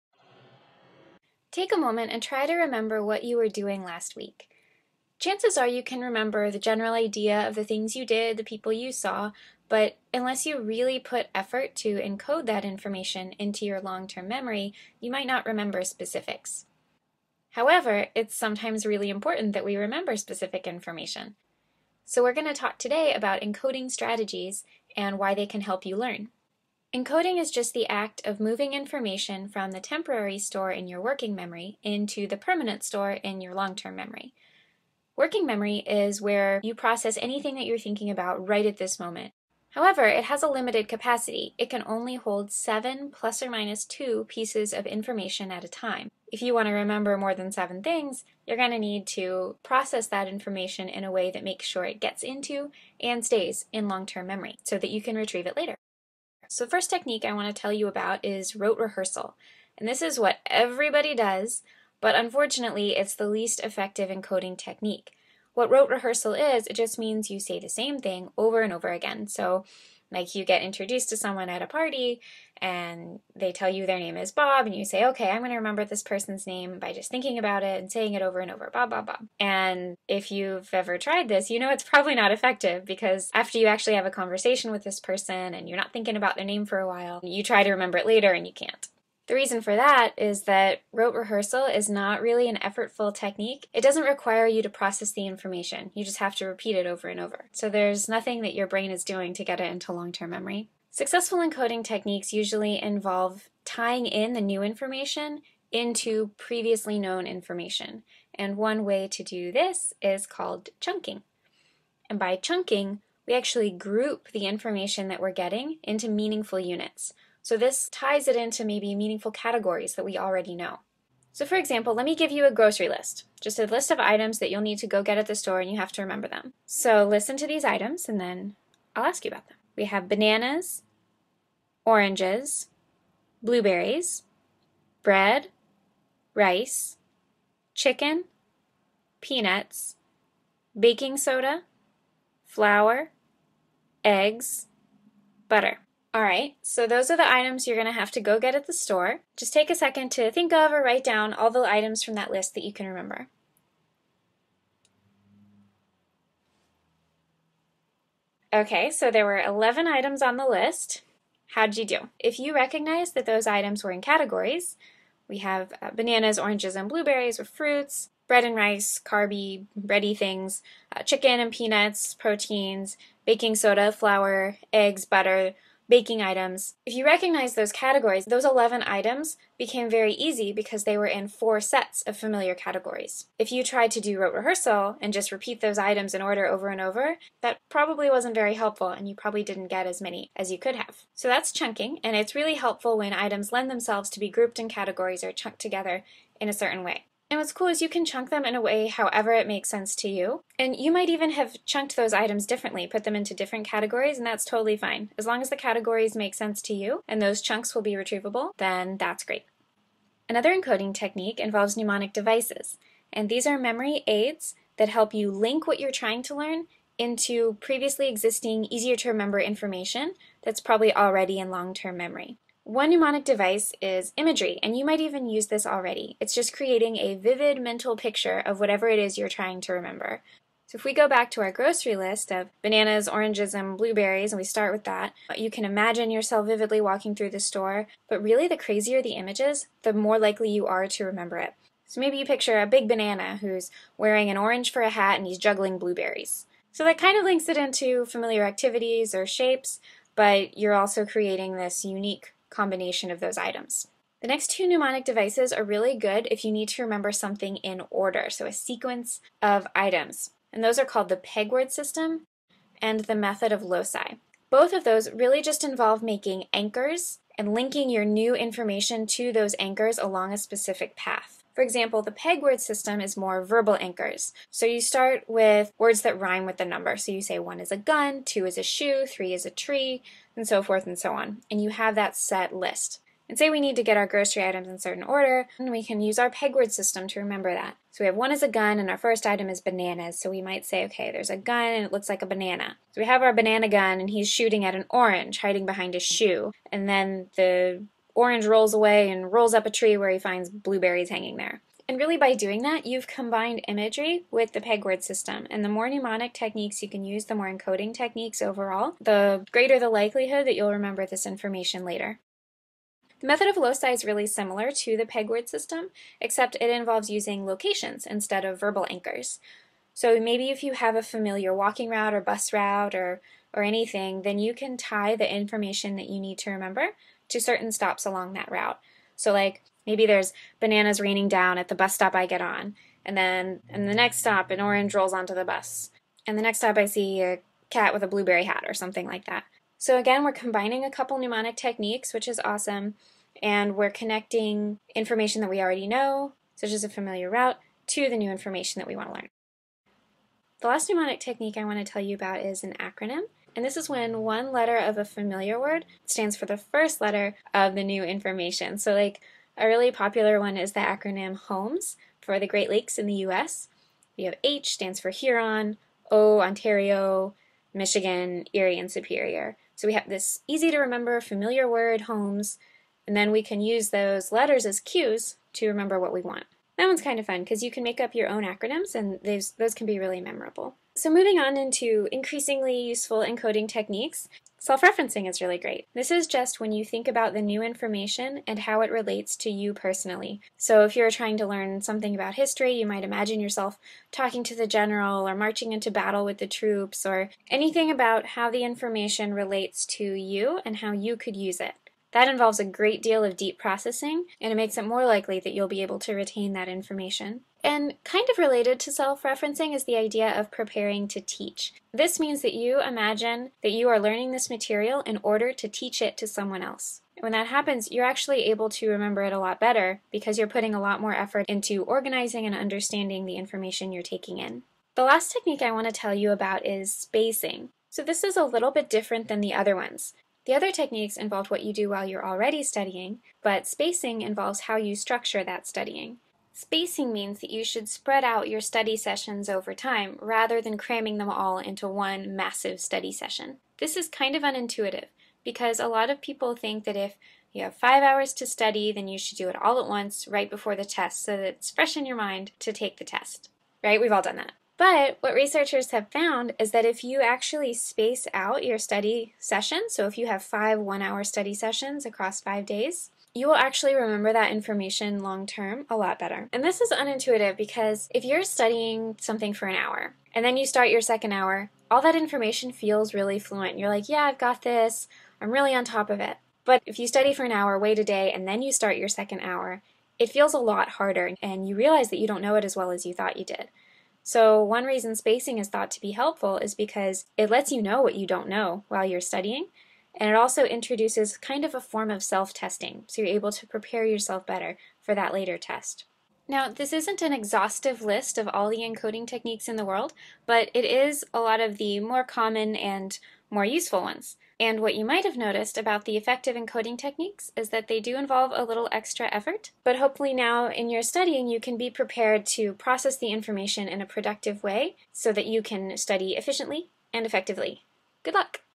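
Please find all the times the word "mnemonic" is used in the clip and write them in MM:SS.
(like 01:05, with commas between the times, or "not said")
03:31, 03:42, 04:14, 05:05, 05:41, 05:50.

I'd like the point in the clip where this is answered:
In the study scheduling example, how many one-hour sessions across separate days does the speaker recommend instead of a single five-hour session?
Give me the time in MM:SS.
07:40.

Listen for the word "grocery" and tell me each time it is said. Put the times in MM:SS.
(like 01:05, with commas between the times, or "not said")
02:02, 03:51, 04:44.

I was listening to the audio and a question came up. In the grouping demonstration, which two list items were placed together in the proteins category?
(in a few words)
chicken and peanuts.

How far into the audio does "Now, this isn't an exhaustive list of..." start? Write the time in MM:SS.
08:16.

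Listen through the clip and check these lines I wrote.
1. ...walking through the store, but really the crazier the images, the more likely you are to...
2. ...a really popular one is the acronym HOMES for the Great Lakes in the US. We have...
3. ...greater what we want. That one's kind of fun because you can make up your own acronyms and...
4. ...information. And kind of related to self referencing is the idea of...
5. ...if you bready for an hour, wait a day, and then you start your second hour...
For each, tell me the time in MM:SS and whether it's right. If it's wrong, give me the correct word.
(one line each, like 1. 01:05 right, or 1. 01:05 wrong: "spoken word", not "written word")
1. 03:56 right
2. 05:59 right
3. 06:15 wrong: "remember", not "greater"
4. 06:46 right
5. 07:56 wrong: "study", not "bready".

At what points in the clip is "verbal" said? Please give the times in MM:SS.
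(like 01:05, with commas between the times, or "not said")
04:33, 05:18.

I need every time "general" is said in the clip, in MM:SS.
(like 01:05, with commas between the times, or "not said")
00:06, 06:34.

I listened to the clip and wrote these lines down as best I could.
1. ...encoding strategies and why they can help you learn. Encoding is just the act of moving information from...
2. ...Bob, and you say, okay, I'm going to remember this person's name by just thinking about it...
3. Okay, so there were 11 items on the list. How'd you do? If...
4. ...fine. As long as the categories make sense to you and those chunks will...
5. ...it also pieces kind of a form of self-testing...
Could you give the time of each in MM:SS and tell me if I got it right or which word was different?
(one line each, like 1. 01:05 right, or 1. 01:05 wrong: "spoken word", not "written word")
1. 00:23 right
2. 01:14 right
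3. 02:38 right
4. 03:24 right
5. 08:10 wrong: "introduces", not "pieces".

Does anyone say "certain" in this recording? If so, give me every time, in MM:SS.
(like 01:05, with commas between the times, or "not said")
03:16, 04:44, 05:27.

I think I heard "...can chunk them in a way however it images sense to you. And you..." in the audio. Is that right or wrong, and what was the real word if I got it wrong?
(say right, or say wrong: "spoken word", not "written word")
wrong: "makes", not "images".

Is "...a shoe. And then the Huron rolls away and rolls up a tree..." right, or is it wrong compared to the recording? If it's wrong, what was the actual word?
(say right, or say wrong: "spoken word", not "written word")
wrong: "Orange", not "Huron".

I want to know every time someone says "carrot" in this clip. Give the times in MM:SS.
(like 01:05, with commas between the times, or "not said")
not said.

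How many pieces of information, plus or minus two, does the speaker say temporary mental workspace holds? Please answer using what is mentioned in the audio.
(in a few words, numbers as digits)
7.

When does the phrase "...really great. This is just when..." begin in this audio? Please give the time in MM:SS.
06:25.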